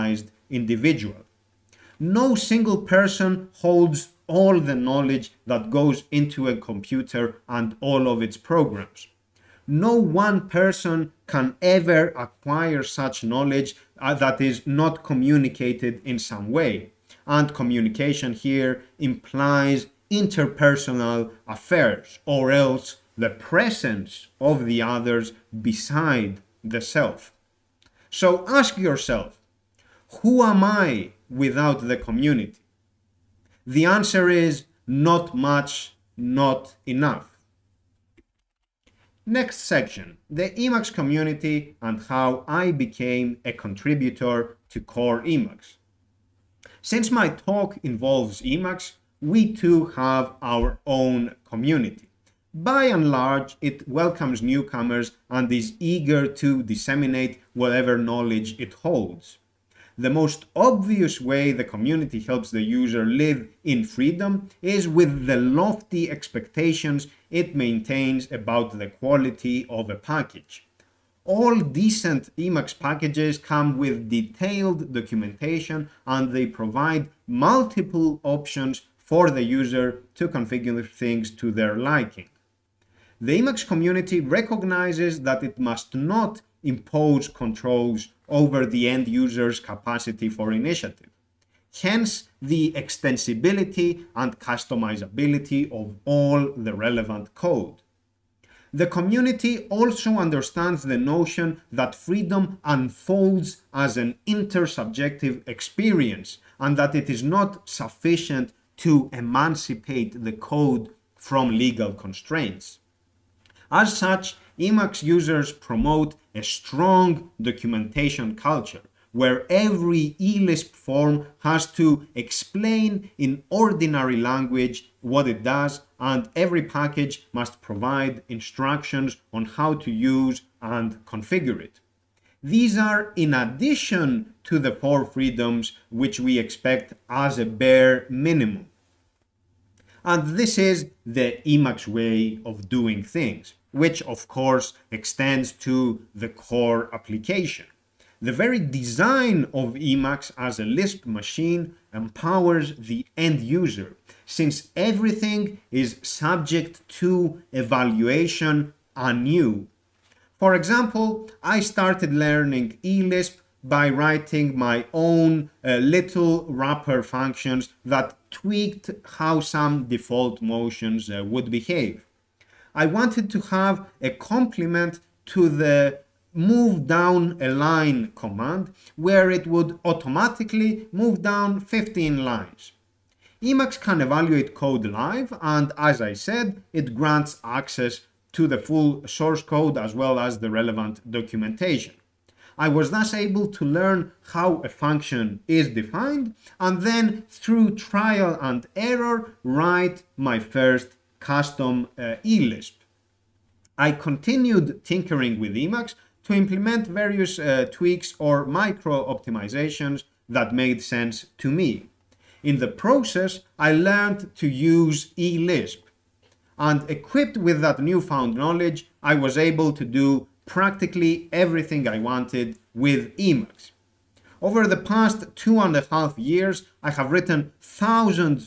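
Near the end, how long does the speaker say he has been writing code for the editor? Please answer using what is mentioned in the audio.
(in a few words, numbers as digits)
2.5 years.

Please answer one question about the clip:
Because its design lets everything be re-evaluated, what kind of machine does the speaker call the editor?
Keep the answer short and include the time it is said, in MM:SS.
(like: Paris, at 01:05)
a Lisp machine, at 02:30.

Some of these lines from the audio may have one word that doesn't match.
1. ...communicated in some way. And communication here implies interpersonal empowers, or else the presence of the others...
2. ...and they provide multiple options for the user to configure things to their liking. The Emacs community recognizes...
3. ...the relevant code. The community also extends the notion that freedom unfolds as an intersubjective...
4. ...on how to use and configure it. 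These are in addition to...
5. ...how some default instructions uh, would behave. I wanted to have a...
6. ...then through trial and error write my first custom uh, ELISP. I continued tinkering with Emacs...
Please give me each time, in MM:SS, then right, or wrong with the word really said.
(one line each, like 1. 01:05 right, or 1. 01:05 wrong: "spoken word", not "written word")
1. 00:15 wrong: "affairs", not "empowers"
2. 01:16 right
3. 01:36 wrong: "understands", not "extends"
4. 02:09 right
5. 02:49 wrong: "motions", not "instructions"
6. 03:16 right.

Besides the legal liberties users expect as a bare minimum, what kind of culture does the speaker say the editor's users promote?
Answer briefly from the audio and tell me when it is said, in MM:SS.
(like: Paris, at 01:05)
documentation culture, at 01:57.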